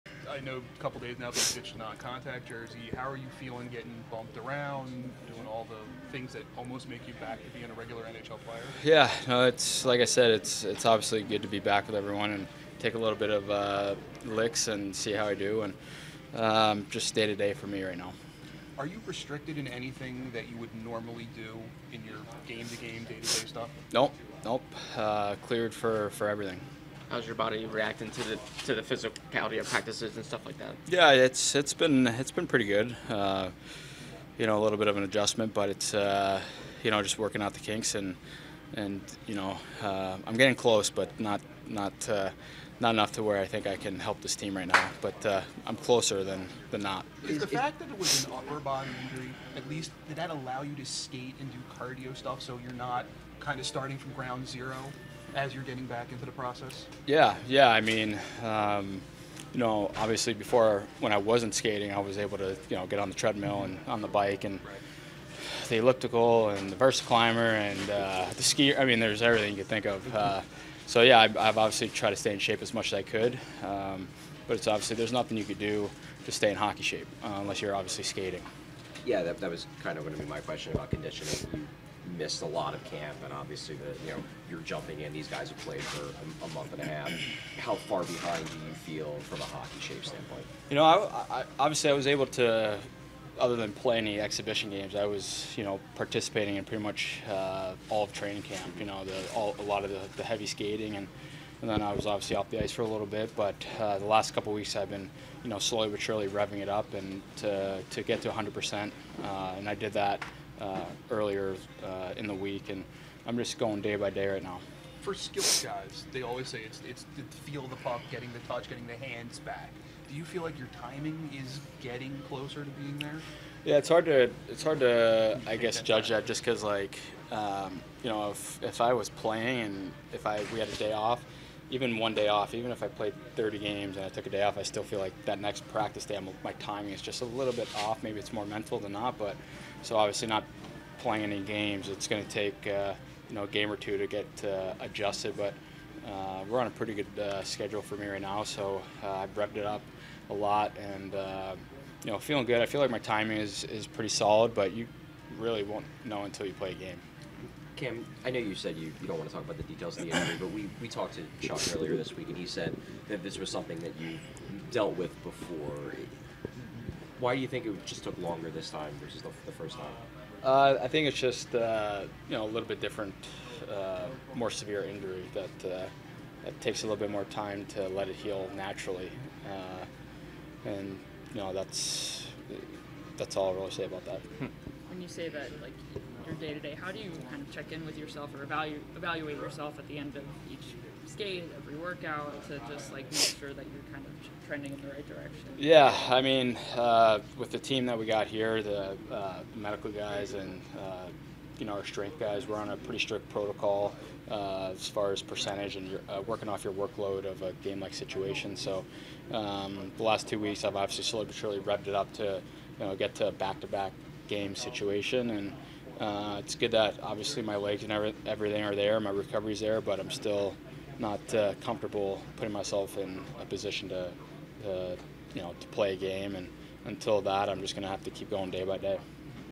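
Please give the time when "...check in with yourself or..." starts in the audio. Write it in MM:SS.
03:07.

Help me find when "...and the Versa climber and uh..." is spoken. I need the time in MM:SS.
01:06.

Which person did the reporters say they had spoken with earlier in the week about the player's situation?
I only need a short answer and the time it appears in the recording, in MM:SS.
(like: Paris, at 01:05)
Chuck, at 02:41.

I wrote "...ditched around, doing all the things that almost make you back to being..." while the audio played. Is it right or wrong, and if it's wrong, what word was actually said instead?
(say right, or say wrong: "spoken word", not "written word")
wrong: "bumped", not "ditched".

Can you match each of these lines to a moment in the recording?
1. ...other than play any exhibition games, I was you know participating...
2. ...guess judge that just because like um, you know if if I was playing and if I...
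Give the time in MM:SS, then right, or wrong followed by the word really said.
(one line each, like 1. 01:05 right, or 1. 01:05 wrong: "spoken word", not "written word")
1. 01:33 right
2. 02:05 right.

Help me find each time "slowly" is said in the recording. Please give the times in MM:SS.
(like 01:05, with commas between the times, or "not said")
01:45, 03:31.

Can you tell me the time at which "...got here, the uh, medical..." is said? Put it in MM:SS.
03:18.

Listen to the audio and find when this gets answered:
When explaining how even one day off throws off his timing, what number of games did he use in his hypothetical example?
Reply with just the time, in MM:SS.
02:13.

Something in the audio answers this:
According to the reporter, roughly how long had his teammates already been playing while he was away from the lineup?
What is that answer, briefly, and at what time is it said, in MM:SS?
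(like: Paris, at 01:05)
a month and a half, at 01:26.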